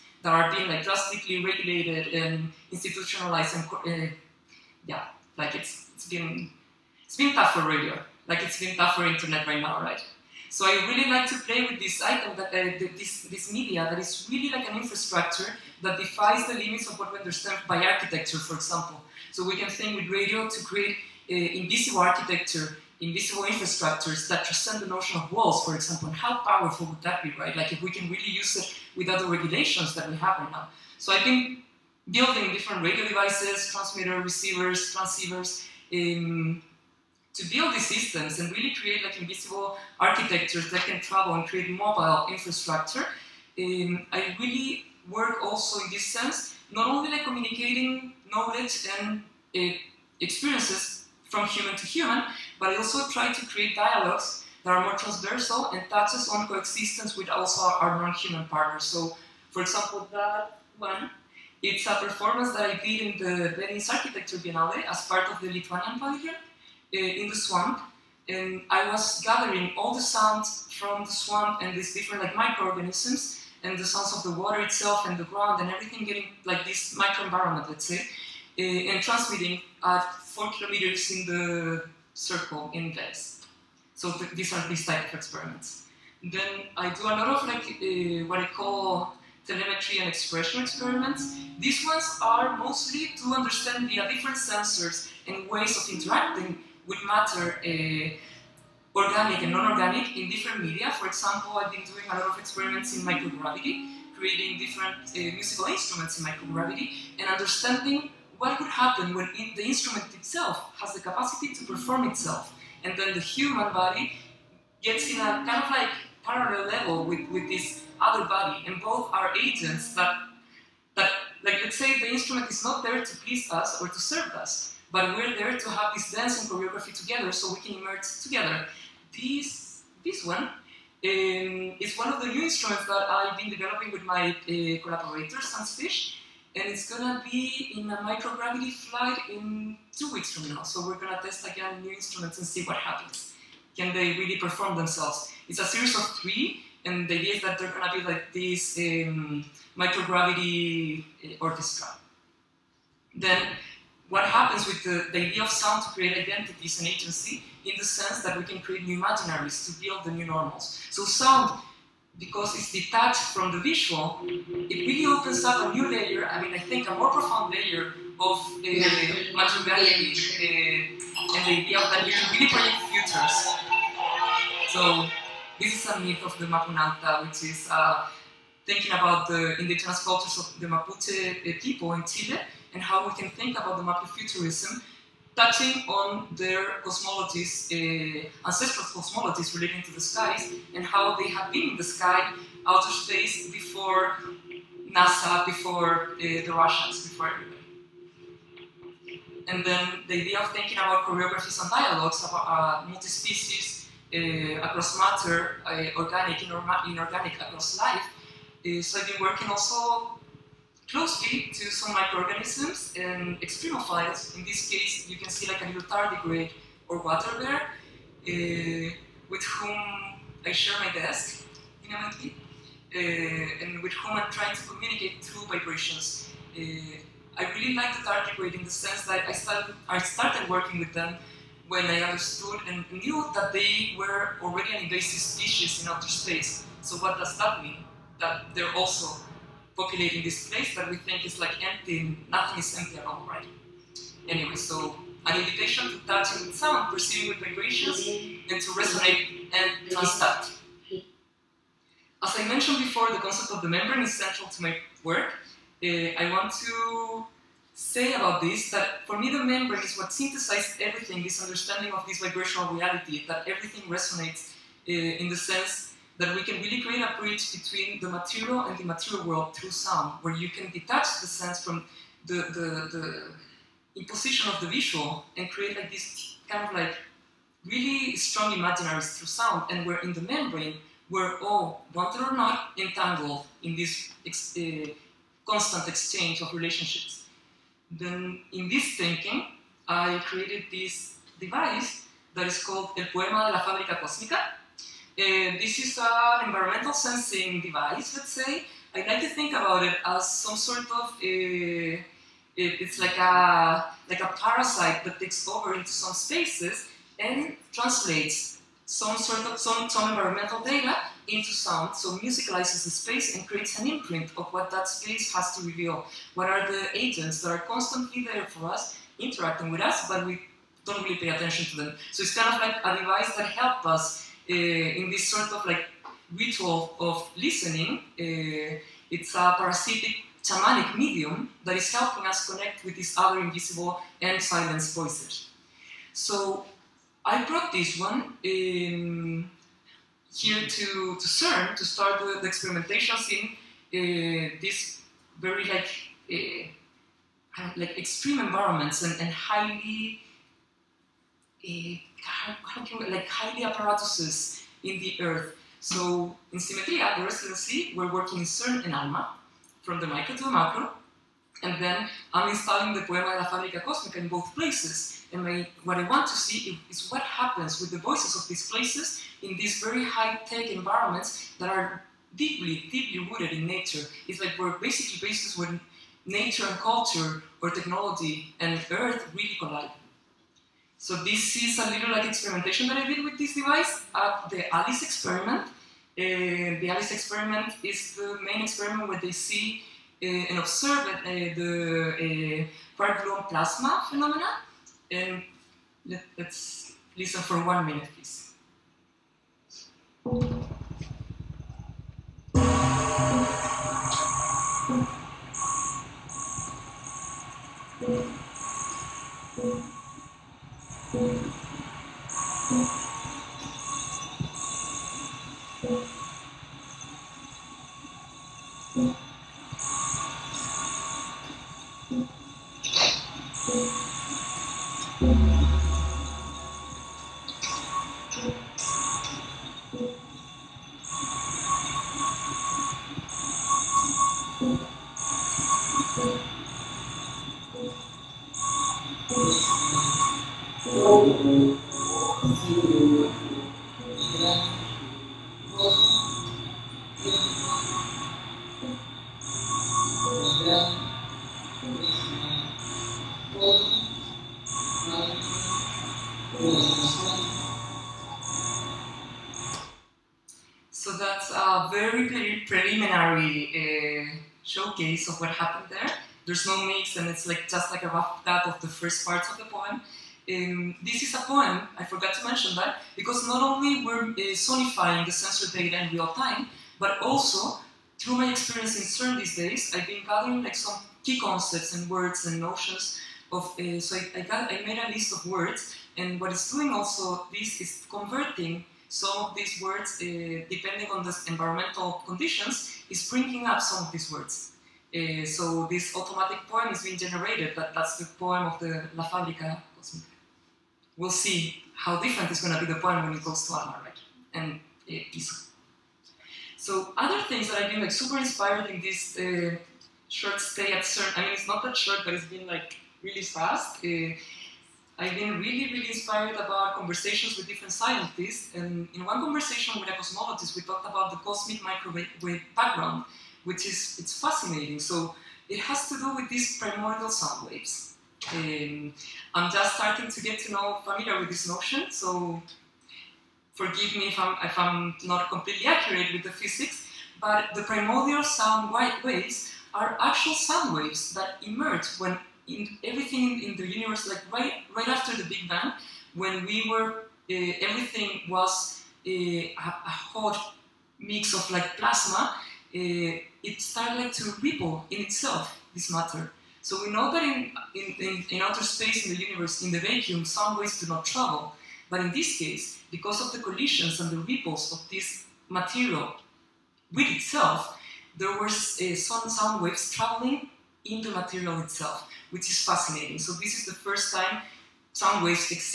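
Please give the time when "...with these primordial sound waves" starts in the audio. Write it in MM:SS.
08:46.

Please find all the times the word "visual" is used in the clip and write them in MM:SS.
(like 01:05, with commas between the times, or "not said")
02:43, 04:34.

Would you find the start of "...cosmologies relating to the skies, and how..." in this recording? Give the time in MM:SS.
03:08.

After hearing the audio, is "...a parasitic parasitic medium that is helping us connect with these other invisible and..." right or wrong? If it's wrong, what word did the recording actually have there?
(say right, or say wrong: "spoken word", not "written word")
wrong: "shamanic", not "parasitic".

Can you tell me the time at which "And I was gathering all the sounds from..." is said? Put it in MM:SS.
01:08.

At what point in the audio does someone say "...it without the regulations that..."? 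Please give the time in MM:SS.
00:28.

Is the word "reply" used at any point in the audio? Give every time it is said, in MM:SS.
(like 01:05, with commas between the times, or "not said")
not said.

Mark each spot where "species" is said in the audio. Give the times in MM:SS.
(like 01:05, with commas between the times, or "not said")
03:22, 03:55.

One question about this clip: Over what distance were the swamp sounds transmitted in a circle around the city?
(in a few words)
4 kilometers.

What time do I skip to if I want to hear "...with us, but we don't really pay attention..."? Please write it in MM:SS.
05:19.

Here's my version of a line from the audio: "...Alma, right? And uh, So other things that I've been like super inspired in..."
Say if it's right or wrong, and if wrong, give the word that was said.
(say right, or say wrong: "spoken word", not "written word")
right.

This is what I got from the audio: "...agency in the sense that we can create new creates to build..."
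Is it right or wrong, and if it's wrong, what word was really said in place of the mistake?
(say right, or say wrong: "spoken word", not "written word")
wrong: "imaginaries", not "creates".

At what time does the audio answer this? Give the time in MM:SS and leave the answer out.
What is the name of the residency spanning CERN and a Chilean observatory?
05:56.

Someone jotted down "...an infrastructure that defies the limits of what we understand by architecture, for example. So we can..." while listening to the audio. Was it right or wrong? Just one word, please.
right.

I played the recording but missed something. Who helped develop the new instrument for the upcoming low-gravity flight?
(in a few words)
Sans Fish.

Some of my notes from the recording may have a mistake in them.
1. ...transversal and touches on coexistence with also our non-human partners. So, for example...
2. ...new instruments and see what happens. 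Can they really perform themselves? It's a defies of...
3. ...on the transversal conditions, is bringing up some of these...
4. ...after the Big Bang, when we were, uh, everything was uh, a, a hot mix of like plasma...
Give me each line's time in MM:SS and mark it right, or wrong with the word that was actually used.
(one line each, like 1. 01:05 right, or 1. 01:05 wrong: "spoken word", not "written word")
1. 00:55 right
2. 02:21 wrong: "series", not "defies"
3. 08:11 wrong: "environmental", not "transversal"
4. 09:05 right.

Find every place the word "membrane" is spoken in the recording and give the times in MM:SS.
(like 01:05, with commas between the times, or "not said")
04:13, 04:19, 04:40.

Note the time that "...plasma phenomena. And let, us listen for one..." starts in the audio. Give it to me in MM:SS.
06:33.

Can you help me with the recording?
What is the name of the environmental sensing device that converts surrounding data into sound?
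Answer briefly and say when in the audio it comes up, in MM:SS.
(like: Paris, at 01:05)
El Poema de la Fábrica Cósmica, at 04:52.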